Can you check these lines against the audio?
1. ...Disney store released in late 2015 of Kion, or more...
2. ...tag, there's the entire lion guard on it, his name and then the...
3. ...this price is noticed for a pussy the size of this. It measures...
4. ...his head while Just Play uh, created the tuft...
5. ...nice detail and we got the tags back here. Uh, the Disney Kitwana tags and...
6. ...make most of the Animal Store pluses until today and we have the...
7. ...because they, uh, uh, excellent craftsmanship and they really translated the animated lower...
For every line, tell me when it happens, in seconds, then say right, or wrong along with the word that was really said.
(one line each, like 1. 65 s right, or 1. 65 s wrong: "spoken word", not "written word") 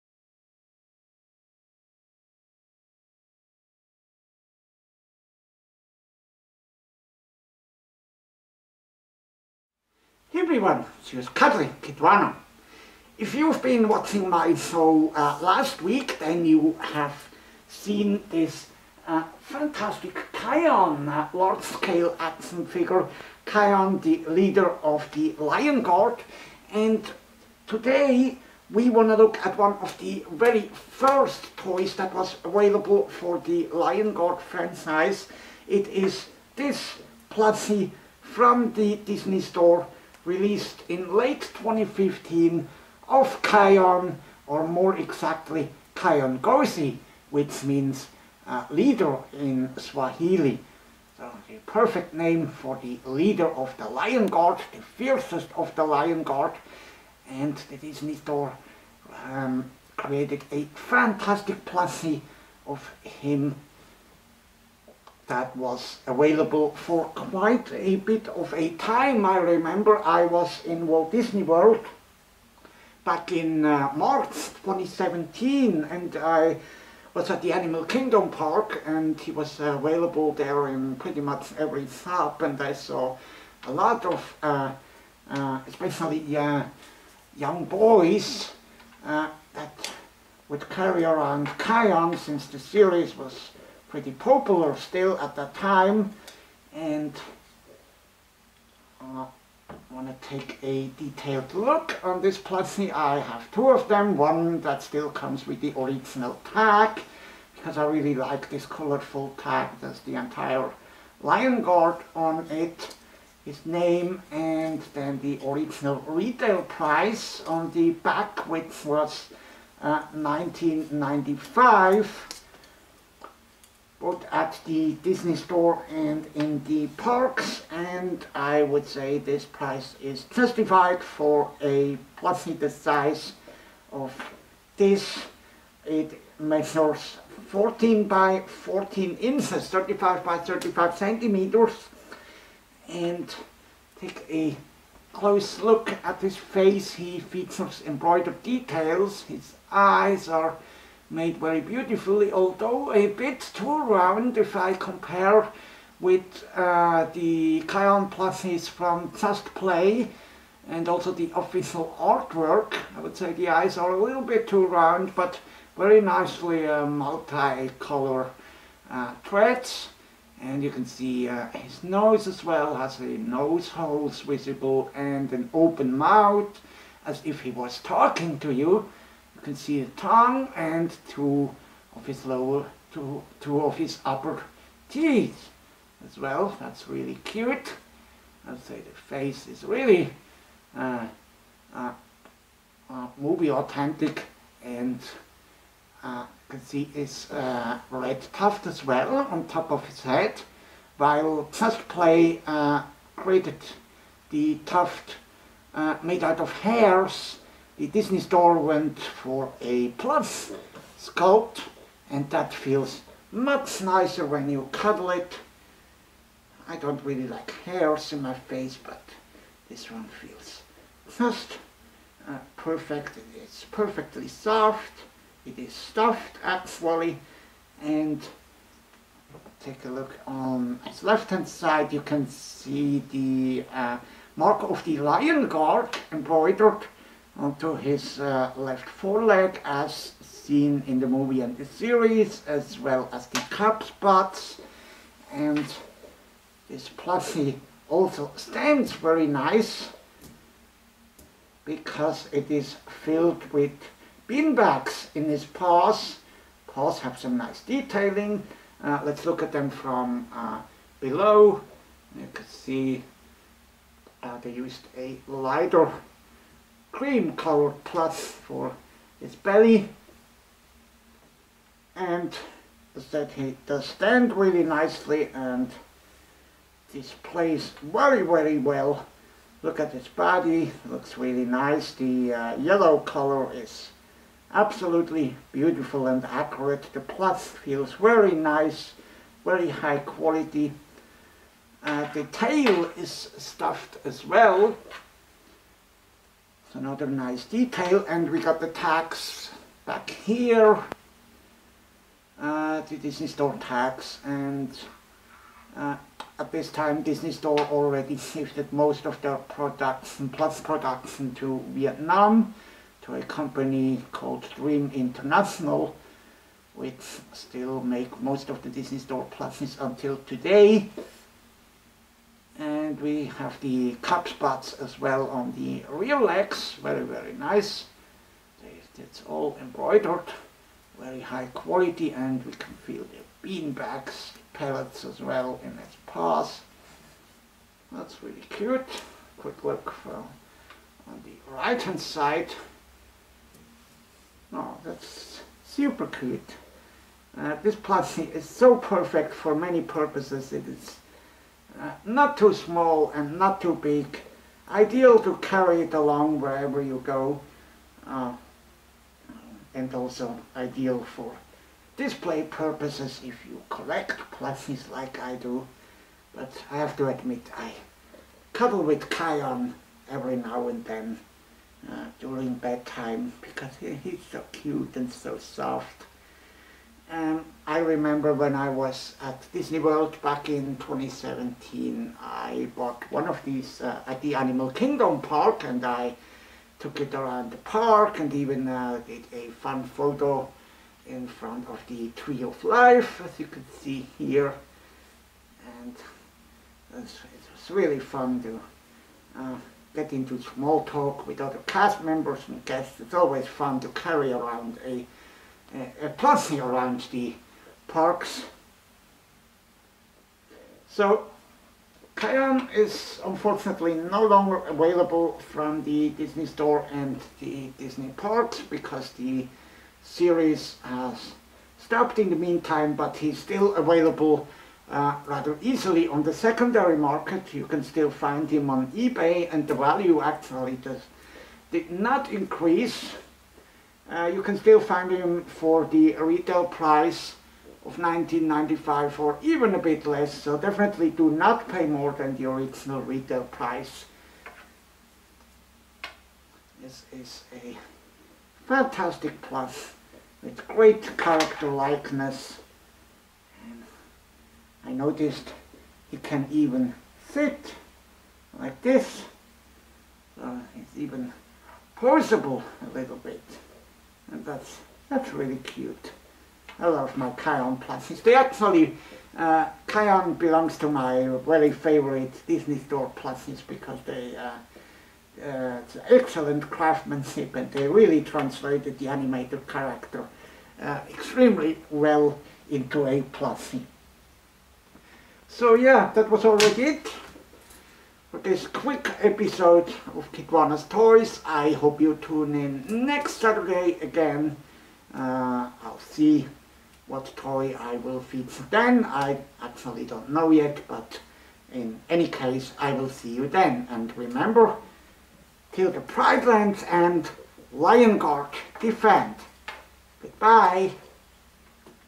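1. 39 s right
2. 109 s right
3. 129 s wrong: "justified", not "noticed"
4. 199 s right
5. 297 s wrong: "Store", not "Kitwana"
6. 317 s wrong: "Disney", not "Animal"
7. 473 s wrong: "character", not "lower".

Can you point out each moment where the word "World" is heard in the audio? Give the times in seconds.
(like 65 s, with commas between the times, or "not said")
71 s, 379 s.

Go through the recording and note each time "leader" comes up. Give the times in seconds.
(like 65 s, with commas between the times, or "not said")
24 s, 48 s, 53 s.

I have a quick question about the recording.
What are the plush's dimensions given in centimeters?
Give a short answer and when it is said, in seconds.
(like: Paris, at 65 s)
35 by 35 centimeters, at 139 s.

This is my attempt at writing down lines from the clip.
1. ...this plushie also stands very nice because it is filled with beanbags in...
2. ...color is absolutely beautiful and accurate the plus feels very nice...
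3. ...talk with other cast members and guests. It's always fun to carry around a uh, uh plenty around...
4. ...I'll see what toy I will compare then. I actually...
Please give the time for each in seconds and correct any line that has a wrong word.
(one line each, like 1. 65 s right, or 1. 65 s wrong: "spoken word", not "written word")
1. 246 s right
2. 282 s right
3. 400 s right
4. 495 s wrong: "feature", not "compare".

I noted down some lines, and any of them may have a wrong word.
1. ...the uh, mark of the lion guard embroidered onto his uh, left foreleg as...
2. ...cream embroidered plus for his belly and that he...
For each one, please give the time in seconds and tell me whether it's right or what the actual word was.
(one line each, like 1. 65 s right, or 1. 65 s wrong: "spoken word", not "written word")
1. 233 s right
2. 266 s wrong: "colored", not "embroidered".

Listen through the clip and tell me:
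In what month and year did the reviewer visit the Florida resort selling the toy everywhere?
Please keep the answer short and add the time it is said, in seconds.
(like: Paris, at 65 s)
March 2017, at 73 s.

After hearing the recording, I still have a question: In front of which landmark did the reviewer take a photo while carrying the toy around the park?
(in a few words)
Tree of Life.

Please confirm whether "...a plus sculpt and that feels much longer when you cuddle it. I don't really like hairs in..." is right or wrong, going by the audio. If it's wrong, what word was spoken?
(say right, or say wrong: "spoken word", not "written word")
wrong: "nicer", not "longer".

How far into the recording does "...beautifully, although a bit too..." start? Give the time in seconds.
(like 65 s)
151 s.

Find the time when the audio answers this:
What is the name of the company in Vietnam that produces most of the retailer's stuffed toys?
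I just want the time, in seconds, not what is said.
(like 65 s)
314 s.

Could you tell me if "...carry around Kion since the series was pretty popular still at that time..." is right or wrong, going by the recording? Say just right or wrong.
right.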